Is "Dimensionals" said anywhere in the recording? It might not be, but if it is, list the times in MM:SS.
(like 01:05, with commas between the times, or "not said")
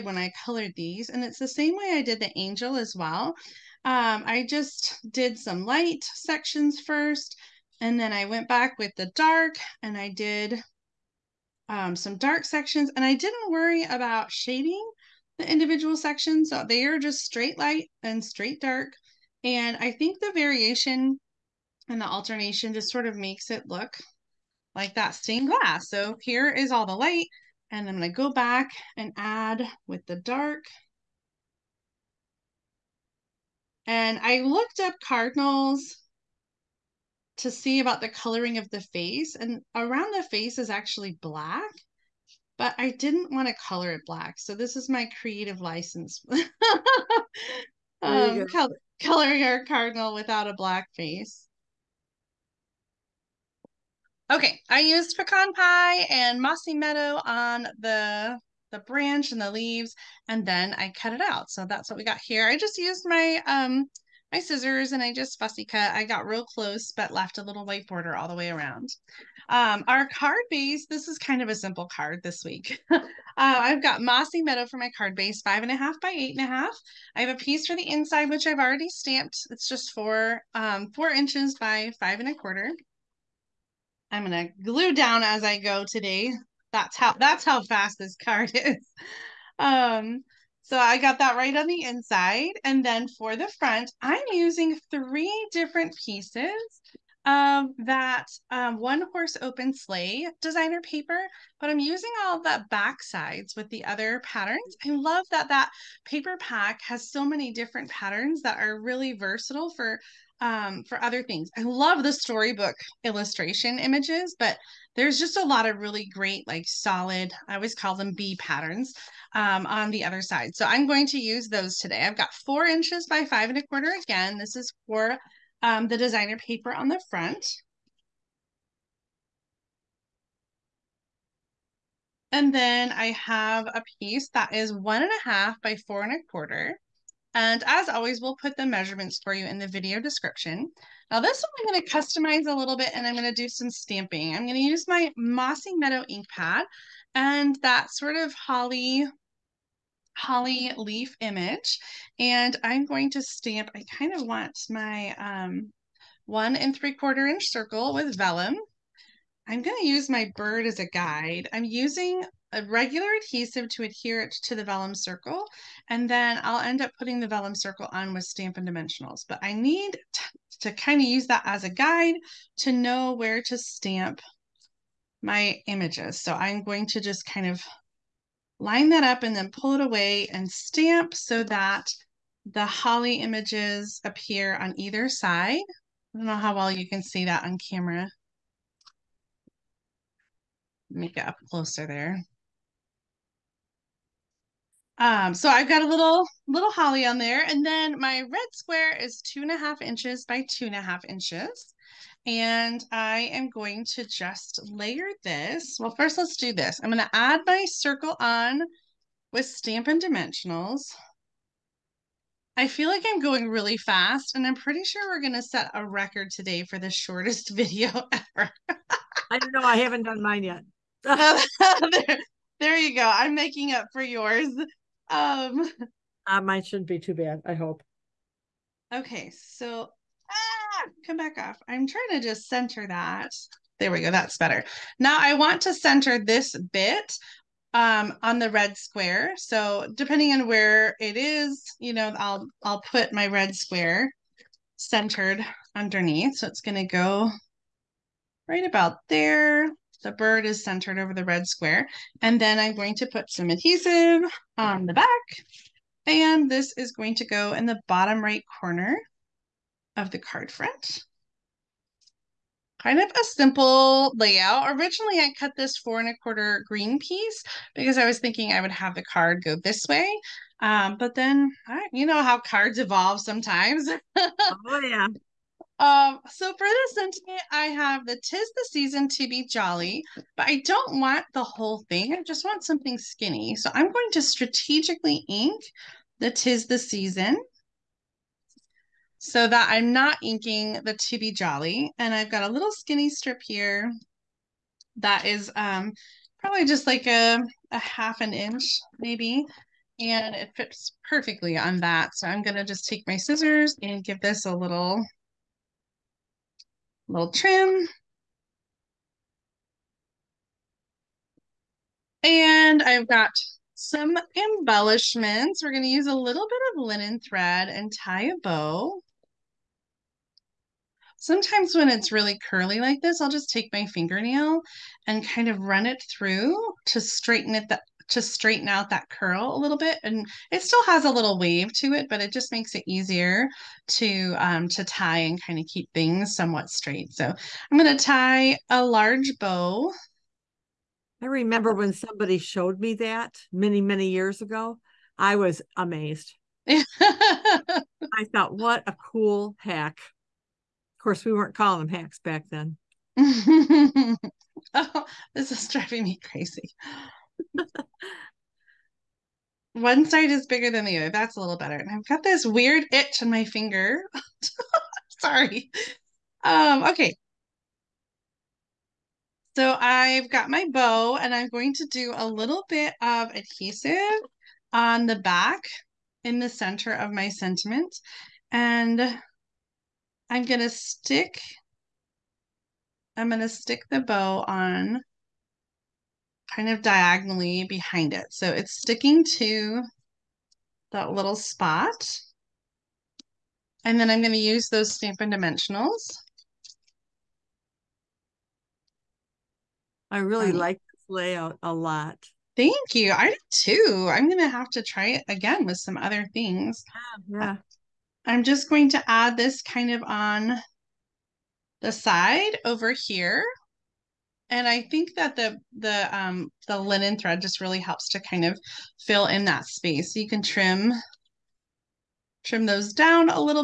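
02:48, 03:29, 06:35.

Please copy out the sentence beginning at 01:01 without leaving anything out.
So that's what we got here.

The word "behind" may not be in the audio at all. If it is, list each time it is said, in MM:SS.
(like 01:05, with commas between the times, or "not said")
06:27.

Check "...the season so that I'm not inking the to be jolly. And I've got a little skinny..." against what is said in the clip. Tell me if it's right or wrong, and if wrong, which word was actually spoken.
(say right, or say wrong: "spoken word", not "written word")
right.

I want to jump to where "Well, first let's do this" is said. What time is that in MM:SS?
03:25.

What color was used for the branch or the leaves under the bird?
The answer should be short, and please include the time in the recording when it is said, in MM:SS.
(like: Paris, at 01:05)
Pecan Pie, at 00:55.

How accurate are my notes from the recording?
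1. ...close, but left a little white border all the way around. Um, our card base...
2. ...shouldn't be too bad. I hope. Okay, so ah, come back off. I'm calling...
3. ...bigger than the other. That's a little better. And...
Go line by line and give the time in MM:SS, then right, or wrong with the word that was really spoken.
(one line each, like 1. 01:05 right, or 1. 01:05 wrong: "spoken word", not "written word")
1. 01:06 right
2. 03:46 wrong: "trying", not "calling"
3. 06:00 right.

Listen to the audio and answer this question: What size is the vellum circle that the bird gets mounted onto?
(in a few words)
1 3/4 inch.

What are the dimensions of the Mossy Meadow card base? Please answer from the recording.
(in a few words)
5 1/2 by 8 1/2.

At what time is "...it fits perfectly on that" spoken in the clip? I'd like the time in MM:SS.
05:00.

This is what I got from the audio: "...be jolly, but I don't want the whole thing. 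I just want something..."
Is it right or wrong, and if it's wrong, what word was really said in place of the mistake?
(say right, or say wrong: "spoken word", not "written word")
right.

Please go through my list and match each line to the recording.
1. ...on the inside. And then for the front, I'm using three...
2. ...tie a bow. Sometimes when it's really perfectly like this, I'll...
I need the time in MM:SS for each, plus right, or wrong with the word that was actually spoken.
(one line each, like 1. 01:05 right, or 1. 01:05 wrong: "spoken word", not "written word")
1. 01:31 right
2. 05:17 wrong: "curly", not "perfectly".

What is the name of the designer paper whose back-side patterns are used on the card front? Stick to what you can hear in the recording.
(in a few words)
One Horse Open Sleigh.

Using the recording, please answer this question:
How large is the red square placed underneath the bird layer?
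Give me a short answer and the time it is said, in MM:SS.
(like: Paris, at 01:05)
2 1/2 by 2 1/2 inches, at 03:19.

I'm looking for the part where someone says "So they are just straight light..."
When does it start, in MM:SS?
00:16.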